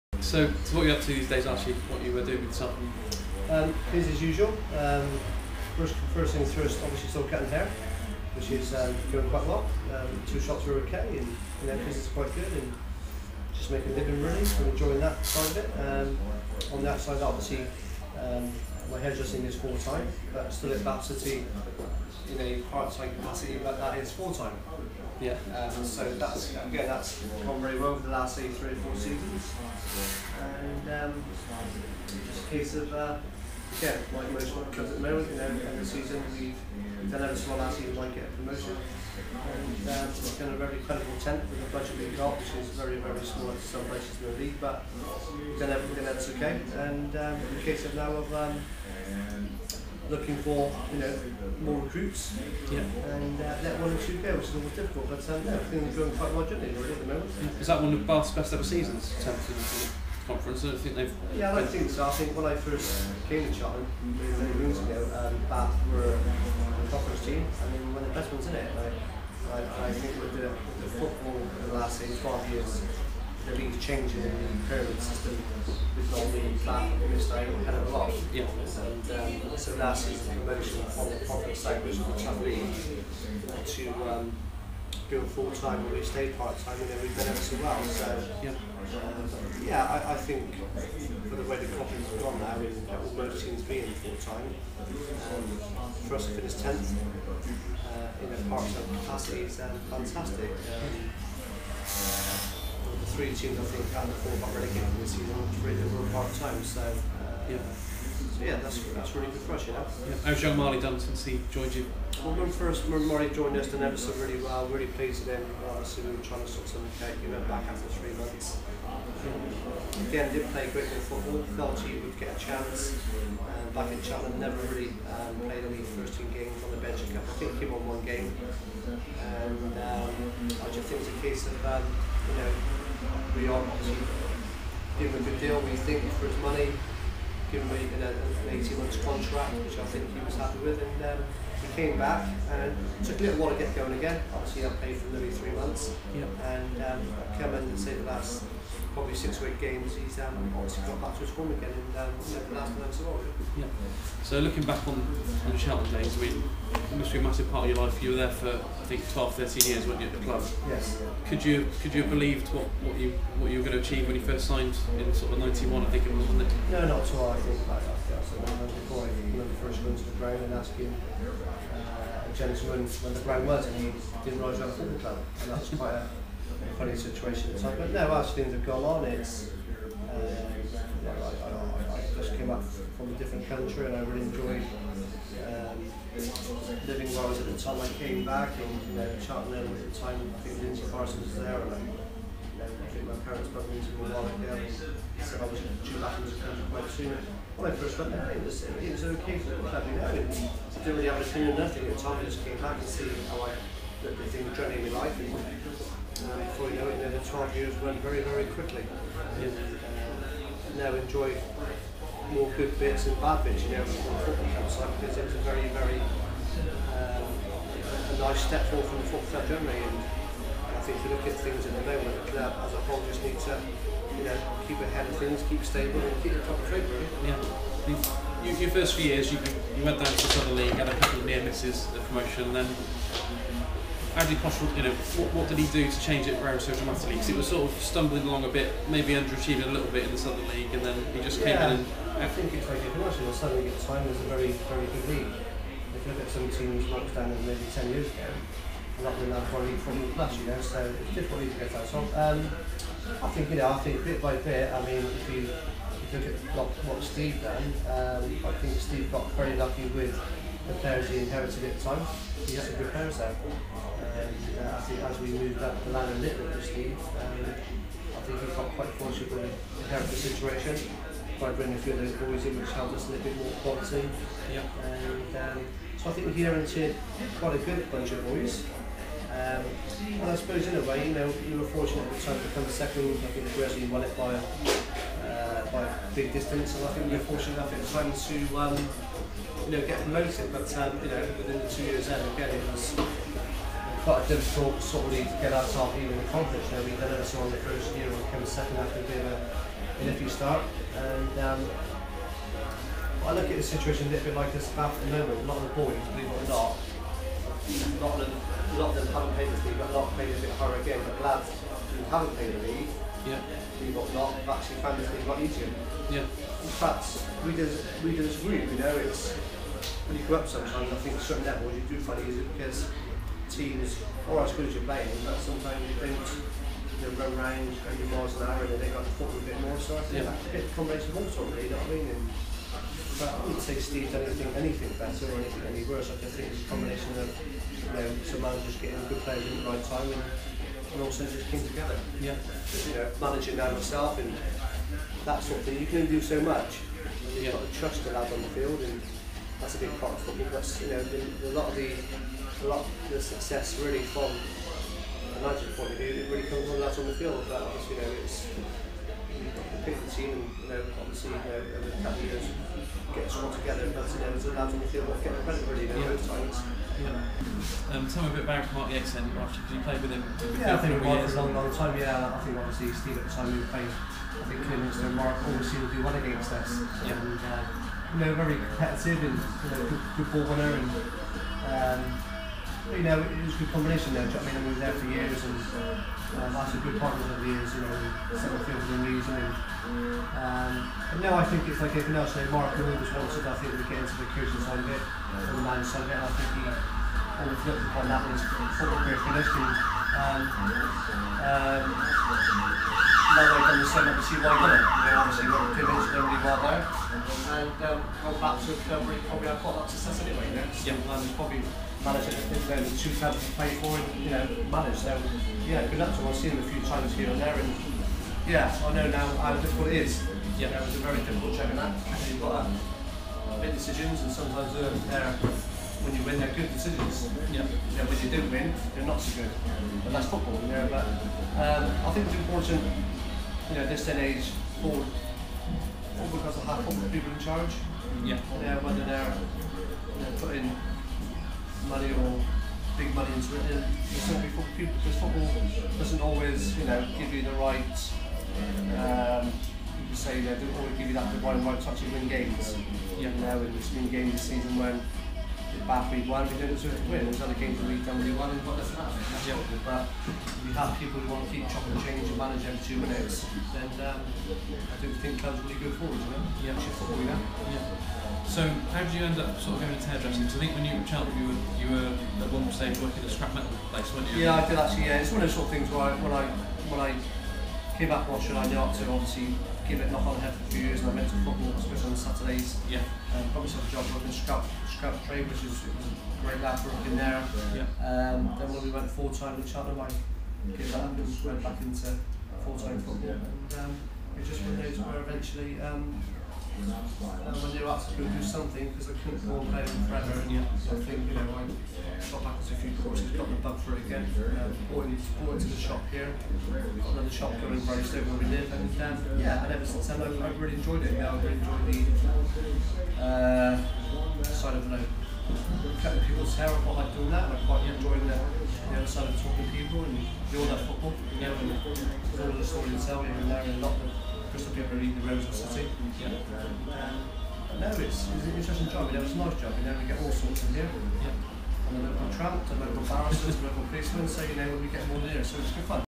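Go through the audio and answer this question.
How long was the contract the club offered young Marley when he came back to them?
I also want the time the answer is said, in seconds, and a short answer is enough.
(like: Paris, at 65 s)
18 months, at 138 s.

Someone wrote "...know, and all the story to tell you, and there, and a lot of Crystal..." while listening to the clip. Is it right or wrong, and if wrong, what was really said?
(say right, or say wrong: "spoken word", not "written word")
right.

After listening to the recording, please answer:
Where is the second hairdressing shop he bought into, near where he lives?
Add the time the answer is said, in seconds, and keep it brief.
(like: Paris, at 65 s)
Brightstone, at 508 s.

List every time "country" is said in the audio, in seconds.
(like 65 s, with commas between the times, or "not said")
183 s, 196 s.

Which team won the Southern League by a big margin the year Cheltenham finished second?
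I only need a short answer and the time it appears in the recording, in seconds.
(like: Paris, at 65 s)
Brazil, at 283 s.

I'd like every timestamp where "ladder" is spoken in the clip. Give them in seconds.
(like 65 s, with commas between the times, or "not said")
265 s.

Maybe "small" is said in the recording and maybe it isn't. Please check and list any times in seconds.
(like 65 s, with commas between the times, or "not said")
37 s, 43 s.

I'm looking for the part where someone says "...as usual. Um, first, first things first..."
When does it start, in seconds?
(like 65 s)
4 s.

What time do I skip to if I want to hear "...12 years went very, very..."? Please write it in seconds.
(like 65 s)
207 s.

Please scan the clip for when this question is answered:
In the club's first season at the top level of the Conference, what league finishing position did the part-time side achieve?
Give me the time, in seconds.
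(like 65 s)
41 s.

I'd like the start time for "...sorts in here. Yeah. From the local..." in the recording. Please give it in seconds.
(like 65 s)
530 s.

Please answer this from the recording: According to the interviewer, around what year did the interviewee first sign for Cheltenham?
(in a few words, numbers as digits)
1991.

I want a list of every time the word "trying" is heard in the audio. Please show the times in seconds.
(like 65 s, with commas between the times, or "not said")
116 s.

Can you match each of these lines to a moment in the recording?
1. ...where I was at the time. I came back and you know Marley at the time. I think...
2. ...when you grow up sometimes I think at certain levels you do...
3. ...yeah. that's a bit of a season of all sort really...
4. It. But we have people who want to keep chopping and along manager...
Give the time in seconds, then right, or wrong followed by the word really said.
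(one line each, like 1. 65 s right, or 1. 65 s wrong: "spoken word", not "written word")
1. 187 s wrong: "Cheltenham", not "Marley"
2. 320 s right
3. 330 s wrong: "combination", not "season"
4. 459 s wrong: "changing", not "along".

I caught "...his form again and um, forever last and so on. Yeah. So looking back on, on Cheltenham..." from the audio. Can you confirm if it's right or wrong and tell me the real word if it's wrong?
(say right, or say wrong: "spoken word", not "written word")
wrong: "never", not "forever".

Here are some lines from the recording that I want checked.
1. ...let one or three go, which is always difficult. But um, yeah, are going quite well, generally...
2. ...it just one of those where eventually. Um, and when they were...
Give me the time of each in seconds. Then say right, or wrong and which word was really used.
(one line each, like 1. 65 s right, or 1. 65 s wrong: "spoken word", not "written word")
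1. 53 s wrong: "two", not "three"
2. 494 s right.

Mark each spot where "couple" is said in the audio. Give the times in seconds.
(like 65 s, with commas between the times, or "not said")
230 s, 362 s.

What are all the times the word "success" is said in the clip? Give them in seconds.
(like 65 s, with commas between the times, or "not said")
353 s, 409 s.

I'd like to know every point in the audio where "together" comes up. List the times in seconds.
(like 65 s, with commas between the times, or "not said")
341 s, 363 s.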